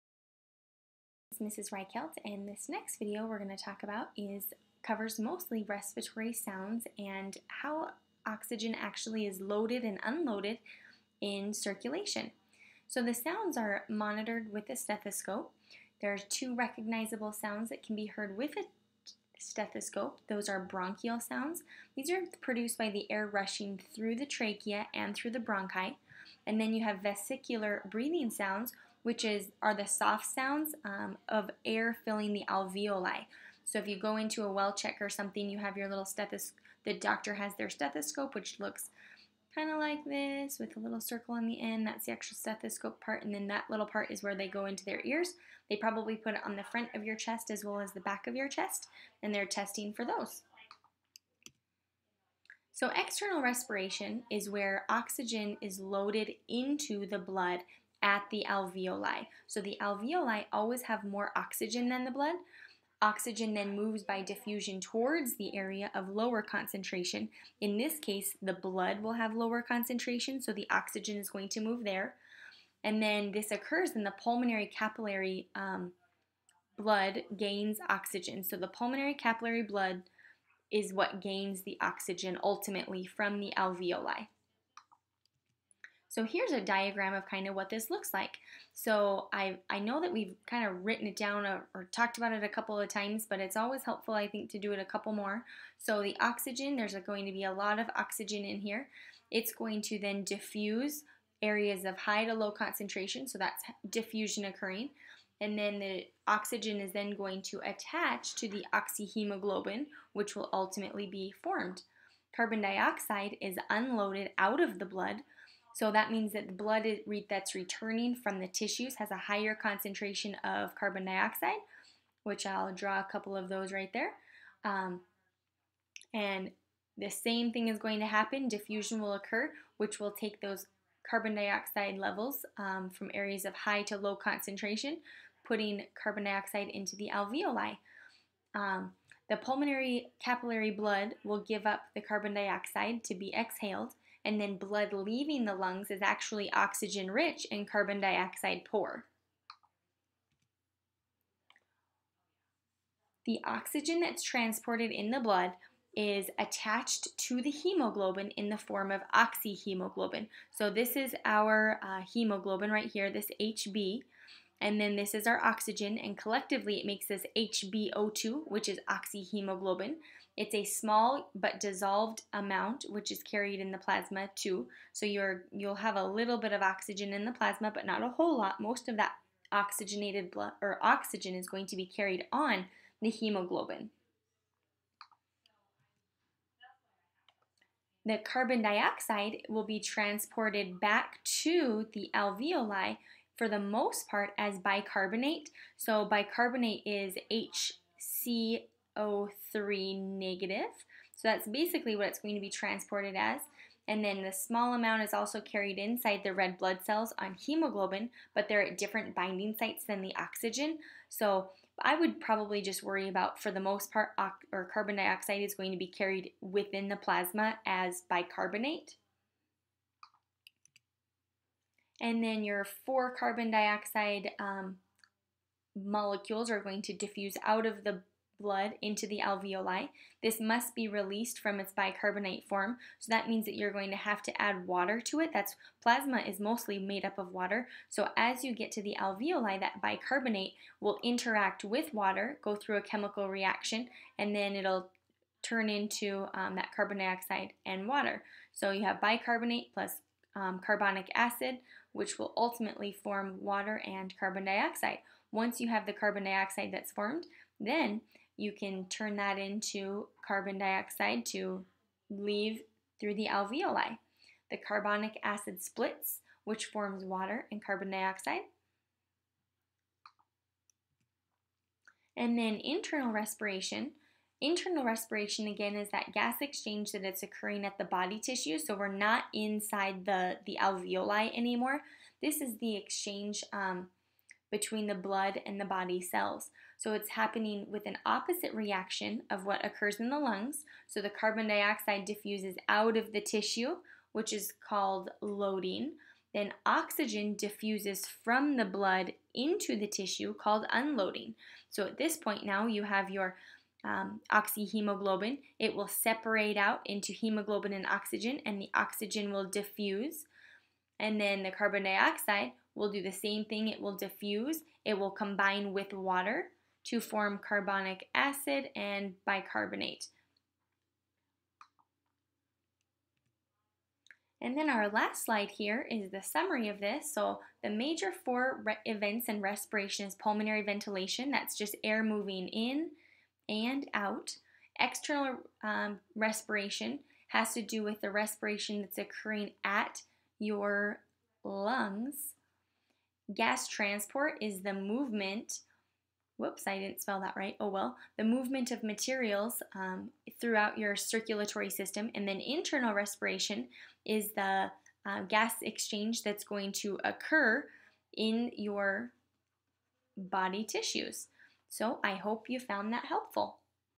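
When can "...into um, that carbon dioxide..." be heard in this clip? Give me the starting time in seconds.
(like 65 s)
245 s.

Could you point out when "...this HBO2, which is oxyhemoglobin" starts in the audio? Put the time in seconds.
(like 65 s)
167 s.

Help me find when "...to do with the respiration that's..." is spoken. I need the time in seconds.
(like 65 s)
337 s.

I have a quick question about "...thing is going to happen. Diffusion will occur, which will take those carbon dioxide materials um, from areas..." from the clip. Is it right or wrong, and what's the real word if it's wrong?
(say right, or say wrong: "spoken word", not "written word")
wrong: "levels", not "materials".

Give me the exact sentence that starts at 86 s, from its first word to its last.
So here's a diagram of kind of what this looks like.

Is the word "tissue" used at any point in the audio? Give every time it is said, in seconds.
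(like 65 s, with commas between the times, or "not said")
118 s, 278 s, 293 s, 299 s, 360 s.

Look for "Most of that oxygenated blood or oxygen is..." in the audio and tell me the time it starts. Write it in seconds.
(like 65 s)
178 s.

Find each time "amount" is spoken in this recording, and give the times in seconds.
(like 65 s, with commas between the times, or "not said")
172 s, 204 s.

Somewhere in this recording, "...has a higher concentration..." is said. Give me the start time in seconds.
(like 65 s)
118 s.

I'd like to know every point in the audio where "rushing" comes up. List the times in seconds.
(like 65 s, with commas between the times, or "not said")
23 s.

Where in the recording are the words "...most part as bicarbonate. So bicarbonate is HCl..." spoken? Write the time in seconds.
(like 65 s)
193 s.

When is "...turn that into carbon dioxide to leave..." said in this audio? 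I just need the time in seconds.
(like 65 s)
258 s.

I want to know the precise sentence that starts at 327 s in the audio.
So the major four events in respiration is pulmonary ventilation, that's just air moving in and out.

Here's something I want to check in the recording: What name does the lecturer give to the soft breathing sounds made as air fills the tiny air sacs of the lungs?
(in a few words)
vesicular breathing sounds.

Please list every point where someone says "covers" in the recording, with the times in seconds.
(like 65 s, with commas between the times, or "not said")
4 s.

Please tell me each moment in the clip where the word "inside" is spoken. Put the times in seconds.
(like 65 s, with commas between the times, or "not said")
205 s, 279 s.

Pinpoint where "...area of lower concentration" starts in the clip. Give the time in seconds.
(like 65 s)
65 s.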